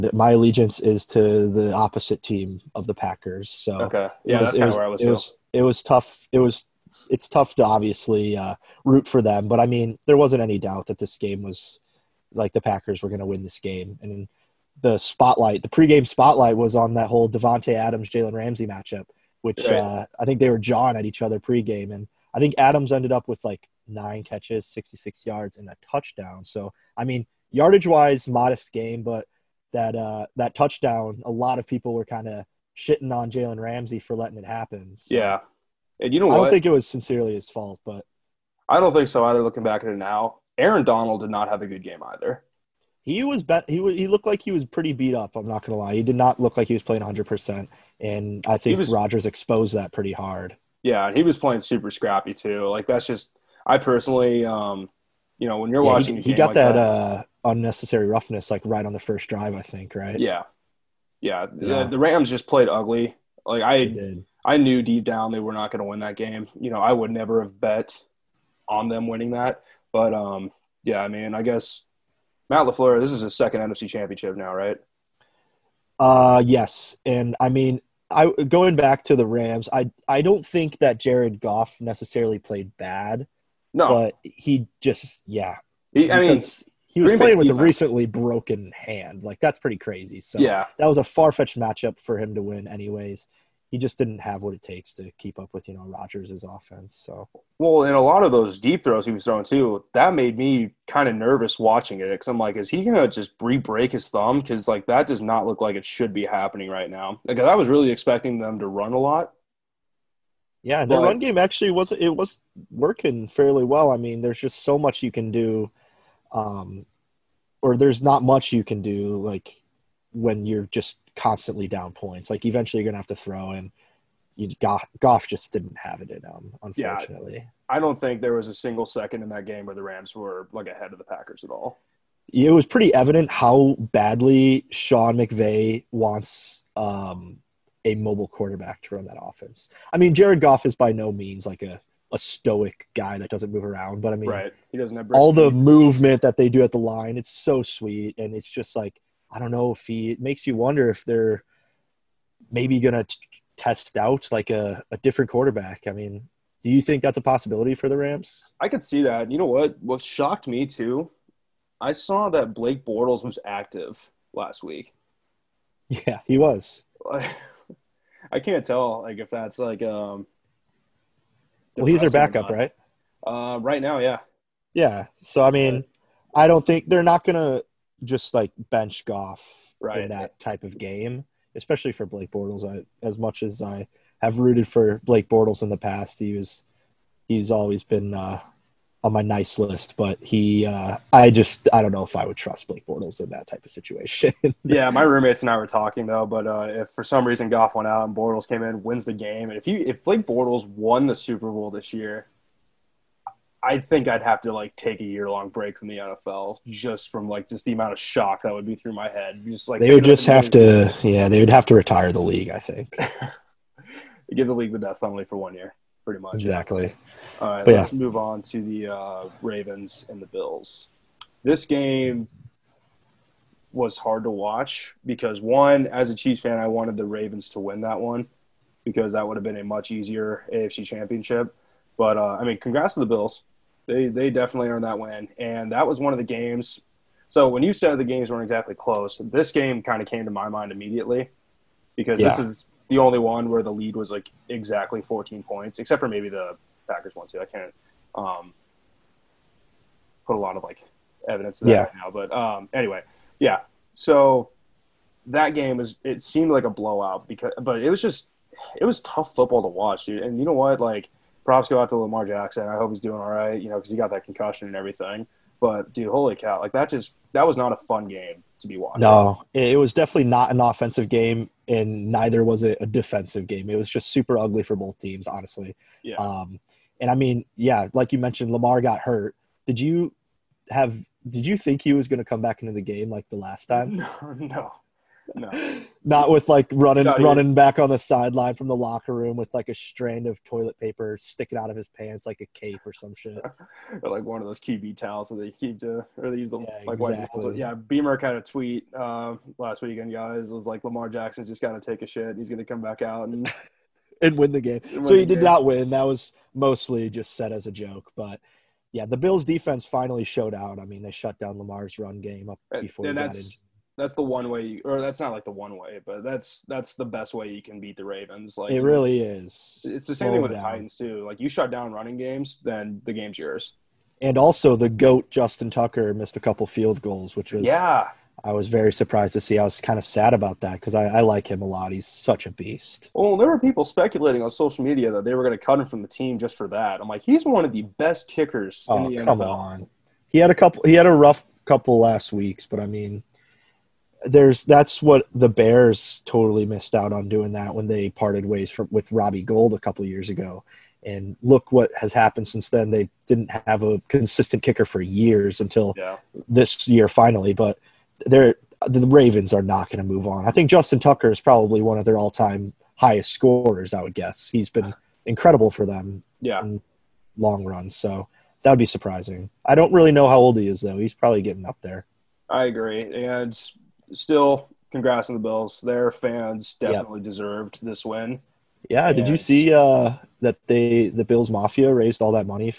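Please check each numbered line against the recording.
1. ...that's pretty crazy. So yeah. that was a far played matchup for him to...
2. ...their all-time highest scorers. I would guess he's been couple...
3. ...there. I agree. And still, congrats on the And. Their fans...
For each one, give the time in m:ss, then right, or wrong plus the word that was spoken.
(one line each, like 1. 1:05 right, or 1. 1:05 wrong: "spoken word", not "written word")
1. 1:29 wrong: "fetched", not "played"
2. 6:02 wrong: "incredible", not "couple"
3. 6:11 wrong: "Bills", not "And".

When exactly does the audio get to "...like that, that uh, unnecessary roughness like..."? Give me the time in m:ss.
0:56.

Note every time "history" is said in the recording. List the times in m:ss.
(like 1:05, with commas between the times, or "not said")
not said.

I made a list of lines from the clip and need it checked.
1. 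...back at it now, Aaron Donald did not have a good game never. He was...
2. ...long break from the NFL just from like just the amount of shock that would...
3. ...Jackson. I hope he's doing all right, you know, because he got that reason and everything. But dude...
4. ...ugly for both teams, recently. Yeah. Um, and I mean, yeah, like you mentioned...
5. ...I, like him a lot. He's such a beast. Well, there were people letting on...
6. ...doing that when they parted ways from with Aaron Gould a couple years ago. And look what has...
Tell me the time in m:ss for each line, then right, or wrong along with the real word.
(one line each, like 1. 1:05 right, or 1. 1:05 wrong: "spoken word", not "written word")
1. 0:39 wrong: "either", not "never"
2. 3:25 right
3. 4:22 wrong: "concussion", not "reason"
4. 4:34 wrong: "honestly", not "recently"
5. 5:31 wrong: "speculating", not "letting"
6. 5:47 wrong: "Robbie", not "Aaron".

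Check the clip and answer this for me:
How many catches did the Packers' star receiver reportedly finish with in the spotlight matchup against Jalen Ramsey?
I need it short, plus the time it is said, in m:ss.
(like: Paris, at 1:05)
9, at 0:23.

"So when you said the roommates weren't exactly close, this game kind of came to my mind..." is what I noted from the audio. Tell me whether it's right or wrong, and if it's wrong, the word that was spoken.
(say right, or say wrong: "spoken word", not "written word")
wrong: "games", not "roommates".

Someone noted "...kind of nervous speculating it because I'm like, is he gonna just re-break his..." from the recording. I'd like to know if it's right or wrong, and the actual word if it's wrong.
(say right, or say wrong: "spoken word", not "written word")
wrong: "watching", not "speculating".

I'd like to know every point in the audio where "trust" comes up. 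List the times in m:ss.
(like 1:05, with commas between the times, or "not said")
3:12.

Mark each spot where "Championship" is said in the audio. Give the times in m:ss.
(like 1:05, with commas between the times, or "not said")
1:13, 3:50.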